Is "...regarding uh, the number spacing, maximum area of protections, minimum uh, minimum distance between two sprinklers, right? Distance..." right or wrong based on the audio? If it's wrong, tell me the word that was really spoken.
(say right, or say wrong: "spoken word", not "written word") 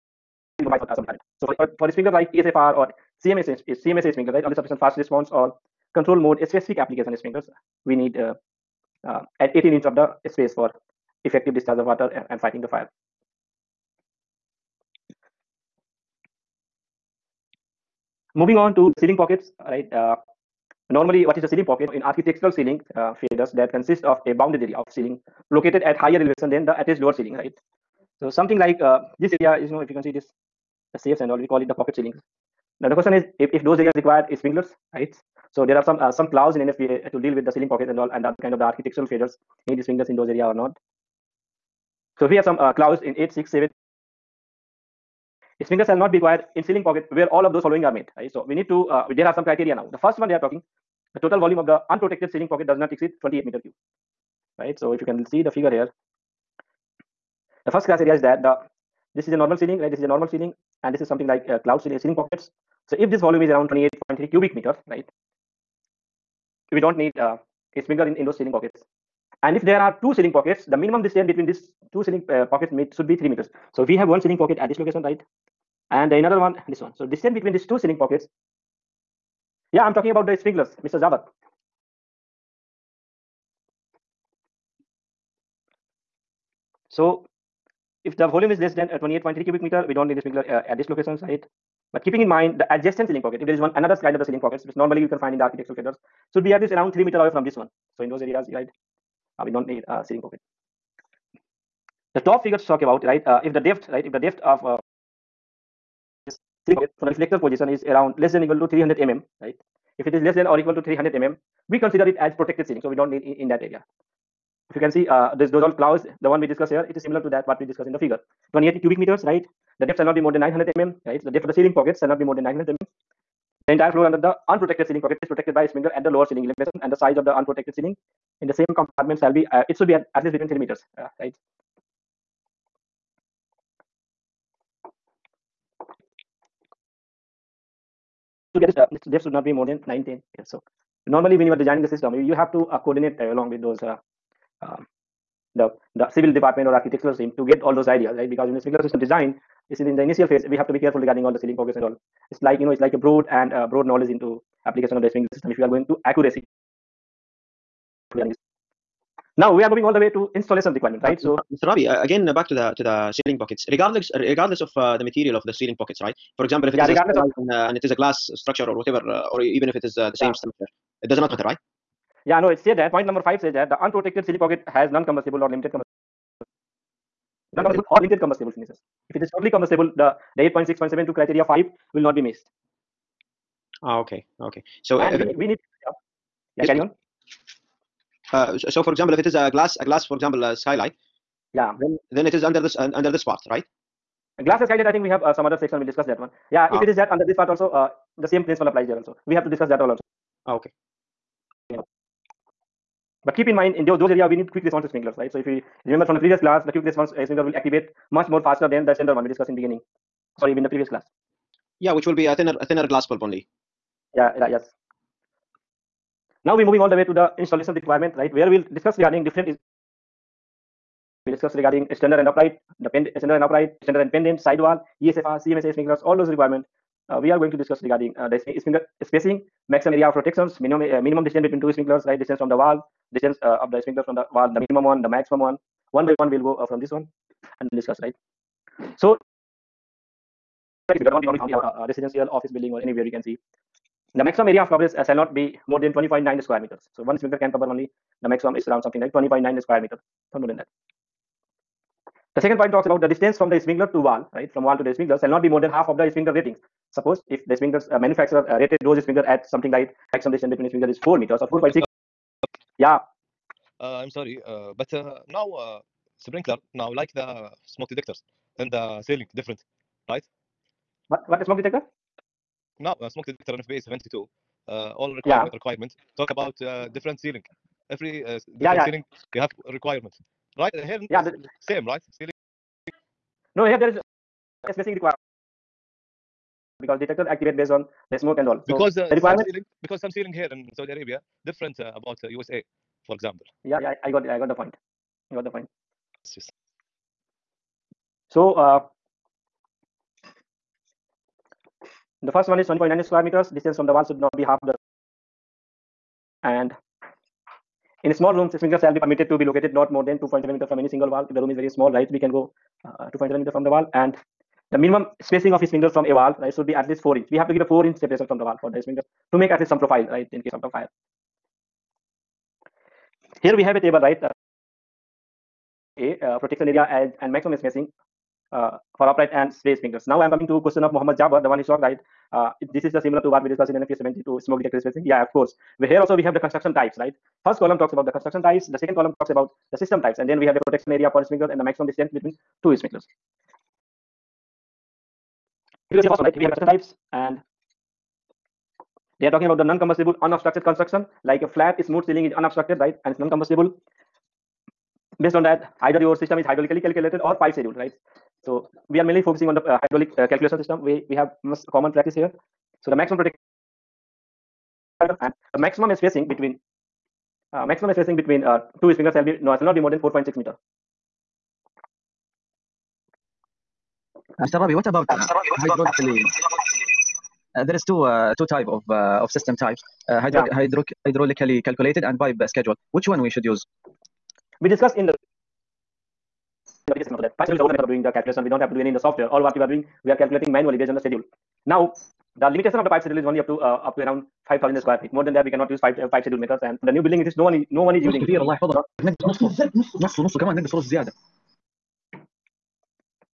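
wrong: "sprinkler", not "number".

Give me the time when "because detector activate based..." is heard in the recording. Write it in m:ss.
4:46.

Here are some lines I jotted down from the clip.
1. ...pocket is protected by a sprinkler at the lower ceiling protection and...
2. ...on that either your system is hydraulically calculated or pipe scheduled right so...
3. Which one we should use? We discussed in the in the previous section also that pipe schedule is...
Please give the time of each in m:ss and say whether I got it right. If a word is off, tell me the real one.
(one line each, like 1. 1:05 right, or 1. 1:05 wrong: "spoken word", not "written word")
1. 2:05 wrong: "elevation", not "protection"
2. 5:55 right
3. 6:22 right.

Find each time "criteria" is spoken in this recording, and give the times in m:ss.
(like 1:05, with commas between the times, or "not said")
0:49, 3:01.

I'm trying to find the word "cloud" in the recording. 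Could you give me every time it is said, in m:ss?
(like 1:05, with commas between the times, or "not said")
1:01, 1:55.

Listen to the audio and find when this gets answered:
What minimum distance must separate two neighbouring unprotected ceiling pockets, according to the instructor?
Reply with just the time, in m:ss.
1:13.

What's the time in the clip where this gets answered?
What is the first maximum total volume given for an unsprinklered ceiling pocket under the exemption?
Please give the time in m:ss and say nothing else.
0:53.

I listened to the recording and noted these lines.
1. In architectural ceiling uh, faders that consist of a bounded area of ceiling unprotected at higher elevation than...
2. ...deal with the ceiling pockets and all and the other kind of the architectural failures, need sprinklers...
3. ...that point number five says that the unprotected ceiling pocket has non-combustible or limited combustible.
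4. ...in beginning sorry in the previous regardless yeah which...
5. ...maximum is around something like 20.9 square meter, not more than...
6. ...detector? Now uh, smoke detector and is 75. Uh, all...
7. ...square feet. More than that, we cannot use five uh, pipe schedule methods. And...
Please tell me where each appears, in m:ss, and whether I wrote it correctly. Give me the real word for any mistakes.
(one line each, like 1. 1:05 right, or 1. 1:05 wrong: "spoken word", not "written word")
1. 0:21 wrong: "located", not "unprotected"
2. 0:37 right
3. 2:52 right
4. 3:29 wrong: "class", not "regardless"
5. 4:08 right
6. 4:31 wrong: "72", not "75"
7. 6:34 right.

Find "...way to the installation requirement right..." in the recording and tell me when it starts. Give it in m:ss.
3:36.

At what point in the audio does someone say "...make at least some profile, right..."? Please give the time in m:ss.
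5:19.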